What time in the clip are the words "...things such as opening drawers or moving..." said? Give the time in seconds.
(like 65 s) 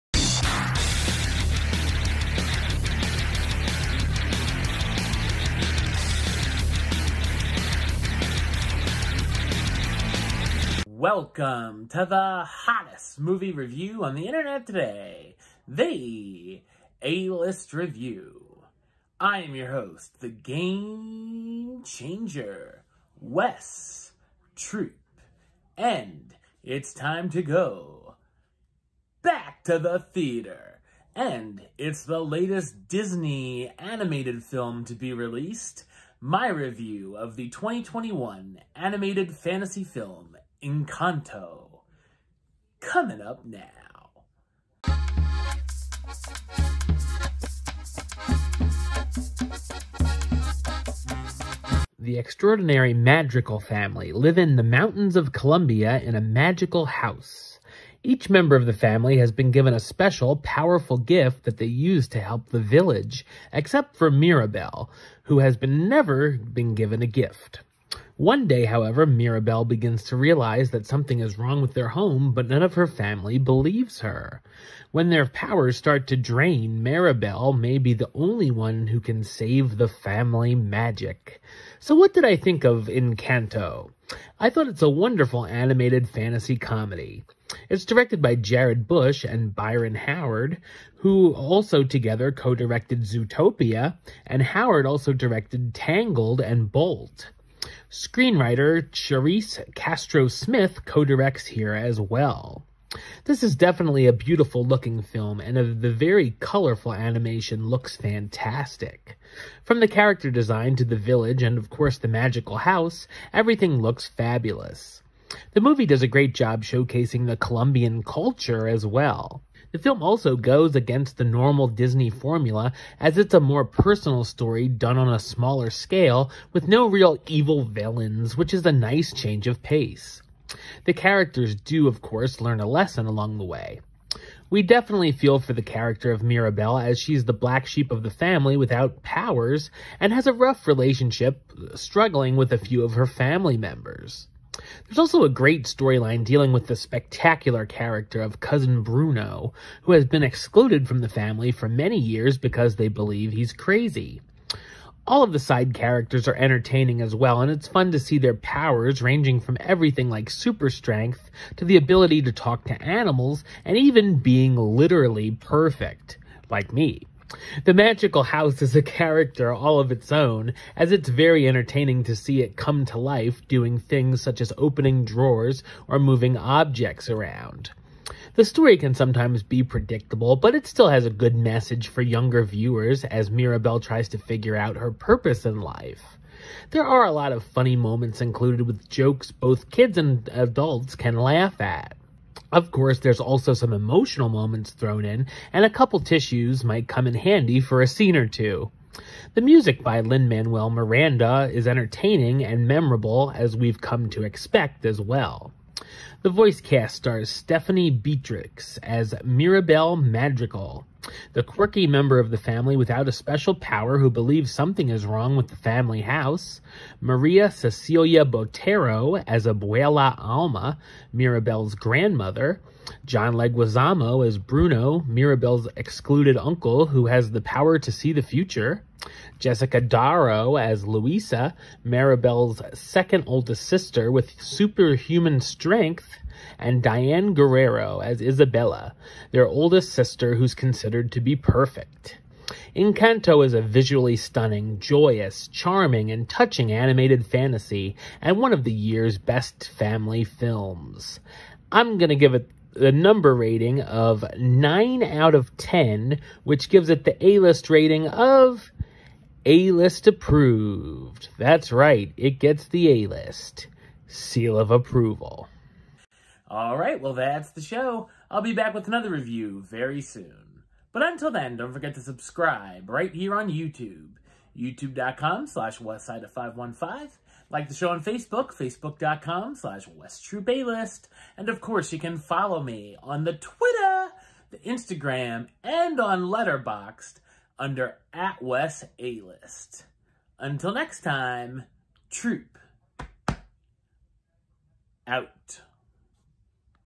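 173 s.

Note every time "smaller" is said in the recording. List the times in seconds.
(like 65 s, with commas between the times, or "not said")
125 s.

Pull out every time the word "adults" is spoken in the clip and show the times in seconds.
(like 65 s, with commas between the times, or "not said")
190 s.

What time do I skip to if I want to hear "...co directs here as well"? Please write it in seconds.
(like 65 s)
100 s.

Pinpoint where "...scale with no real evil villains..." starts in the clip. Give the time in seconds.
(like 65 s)
125 s.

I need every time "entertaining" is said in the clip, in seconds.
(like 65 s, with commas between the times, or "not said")
156 s, 171 s, 201 s.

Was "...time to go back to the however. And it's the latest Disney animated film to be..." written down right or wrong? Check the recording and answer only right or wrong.
wrong.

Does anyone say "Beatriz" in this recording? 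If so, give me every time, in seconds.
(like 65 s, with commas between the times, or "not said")
207 s.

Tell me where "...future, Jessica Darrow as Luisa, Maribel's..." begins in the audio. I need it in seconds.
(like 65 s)
228 s.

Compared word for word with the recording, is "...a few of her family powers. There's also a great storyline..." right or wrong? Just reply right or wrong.
wrong.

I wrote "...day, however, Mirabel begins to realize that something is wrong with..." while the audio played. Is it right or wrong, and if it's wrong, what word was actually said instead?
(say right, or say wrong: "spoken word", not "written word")
right.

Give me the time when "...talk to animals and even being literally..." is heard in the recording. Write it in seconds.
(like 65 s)
162 s.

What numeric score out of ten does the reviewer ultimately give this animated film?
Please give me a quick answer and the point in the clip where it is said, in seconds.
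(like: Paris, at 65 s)
9, at 254 s.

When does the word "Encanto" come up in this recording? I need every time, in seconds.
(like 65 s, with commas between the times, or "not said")
40 s, 82 s, 242 s.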